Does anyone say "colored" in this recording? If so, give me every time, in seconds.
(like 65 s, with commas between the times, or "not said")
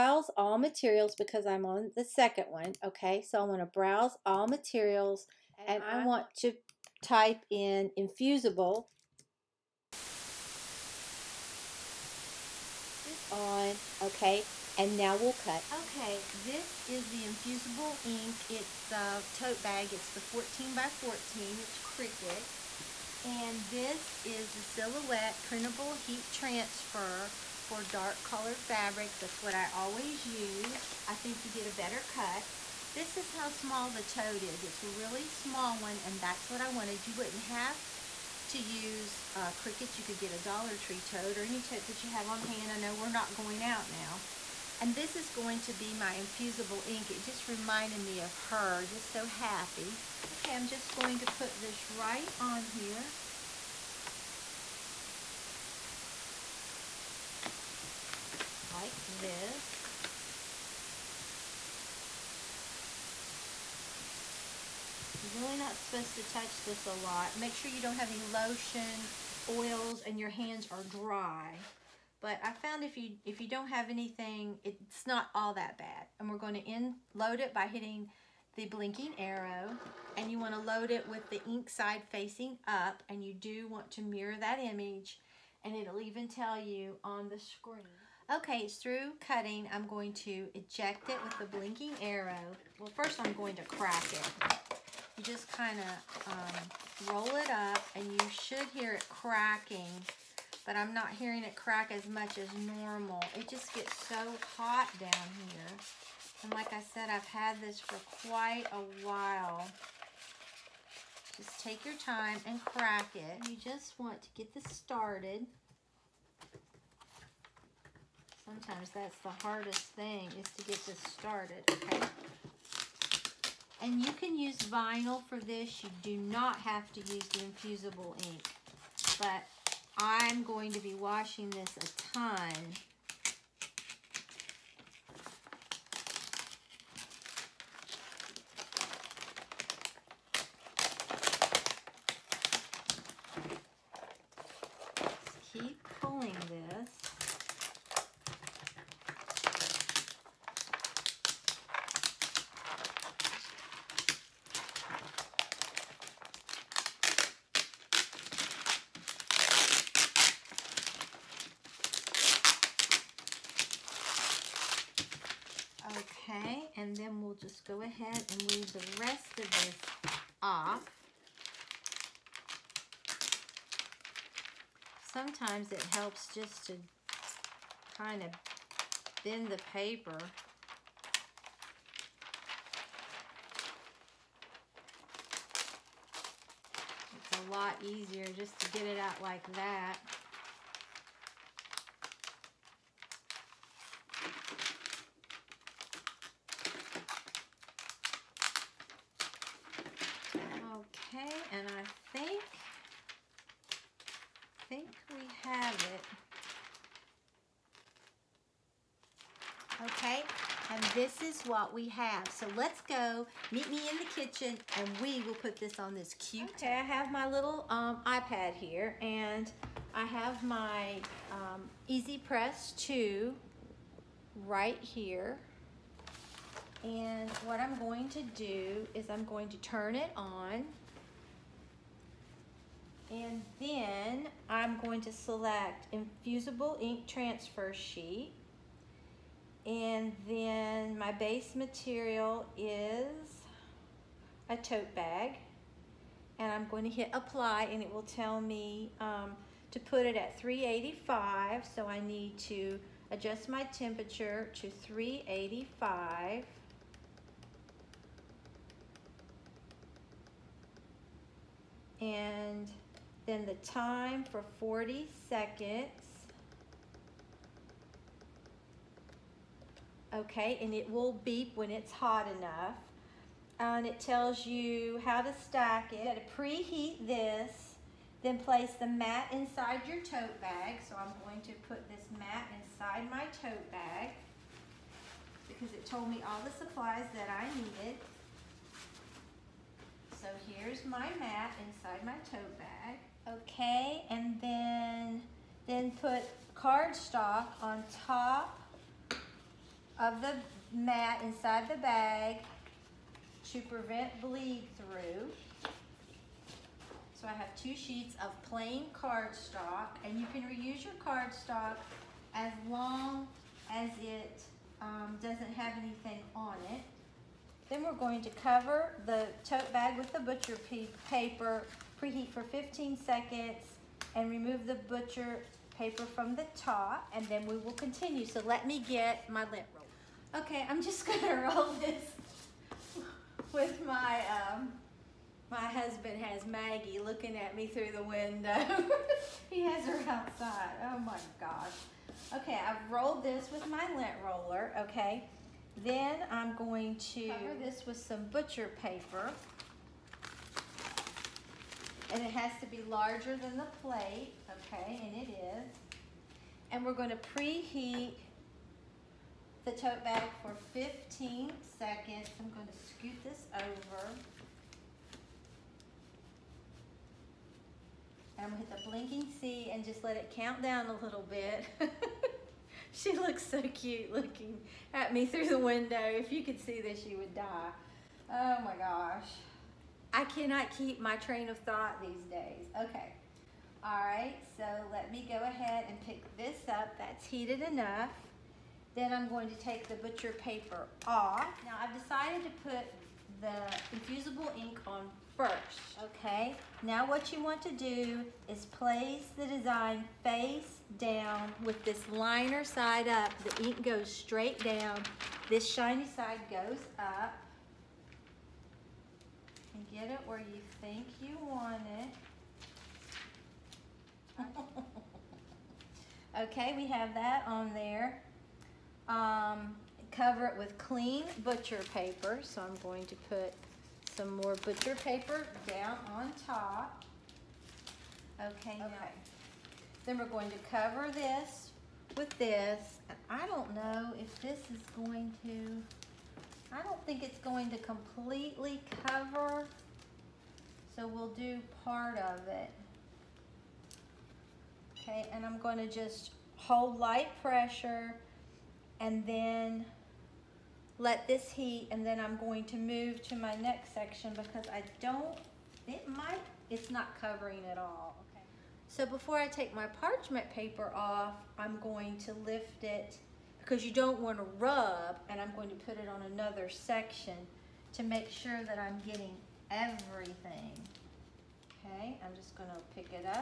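28 s.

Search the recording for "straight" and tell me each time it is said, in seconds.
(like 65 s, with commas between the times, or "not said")
404 s.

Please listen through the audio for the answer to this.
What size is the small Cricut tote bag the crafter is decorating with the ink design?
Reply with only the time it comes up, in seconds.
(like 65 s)
20 s.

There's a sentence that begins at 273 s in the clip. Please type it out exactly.
And it tells you how to stack it.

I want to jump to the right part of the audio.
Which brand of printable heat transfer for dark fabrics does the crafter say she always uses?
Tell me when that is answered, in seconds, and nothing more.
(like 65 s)
24 s.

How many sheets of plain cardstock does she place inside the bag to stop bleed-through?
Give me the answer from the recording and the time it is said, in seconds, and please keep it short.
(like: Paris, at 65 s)
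2, at 307 s.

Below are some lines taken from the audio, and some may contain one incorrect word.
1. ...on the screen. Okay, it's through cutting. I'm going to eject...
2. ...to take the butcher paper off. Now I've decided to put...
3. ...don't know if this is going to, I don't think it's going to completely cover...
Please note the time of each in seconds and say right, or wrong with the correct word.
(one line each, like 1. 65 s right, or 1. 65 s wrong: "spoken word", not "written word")
1. 87 s right
2. 389 s right
3. 433 s right.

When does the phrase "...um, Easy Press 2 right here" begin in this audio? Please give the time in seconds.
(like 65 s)
221 s.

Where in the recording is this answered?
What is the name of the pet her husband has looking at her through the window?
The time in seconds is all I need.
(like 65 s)
336 s.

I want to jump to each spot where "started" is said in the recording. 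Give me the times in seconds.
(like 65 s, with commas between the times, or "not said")
114 s, 121 s.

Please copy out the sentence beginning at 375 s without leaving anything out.
If you could see this, you would die.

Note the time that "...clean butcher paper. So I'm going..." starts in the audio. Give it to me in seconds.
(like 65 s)
420 s.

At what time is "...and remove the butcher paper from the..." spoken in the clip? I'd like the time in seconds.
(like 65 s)
324 s.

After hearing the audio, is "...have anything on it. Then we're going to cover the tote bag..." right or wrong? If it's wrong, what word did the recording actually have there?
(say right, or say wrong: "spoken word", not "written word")
right.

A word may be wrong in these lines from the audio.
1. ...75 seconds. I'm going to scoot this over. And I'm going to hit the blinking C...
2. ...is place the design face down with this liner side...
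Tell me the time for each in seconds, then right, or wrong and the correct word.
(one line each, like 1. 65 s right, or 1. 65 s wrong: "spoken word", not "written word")
1. 360 s wrong: "15", not "75"
2. 398 s right.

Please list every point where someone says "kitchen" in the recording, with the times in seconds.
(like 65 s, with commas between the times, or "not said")
214 s.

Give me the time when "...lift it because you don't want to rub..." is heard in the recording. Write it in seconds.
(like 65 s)
462 s.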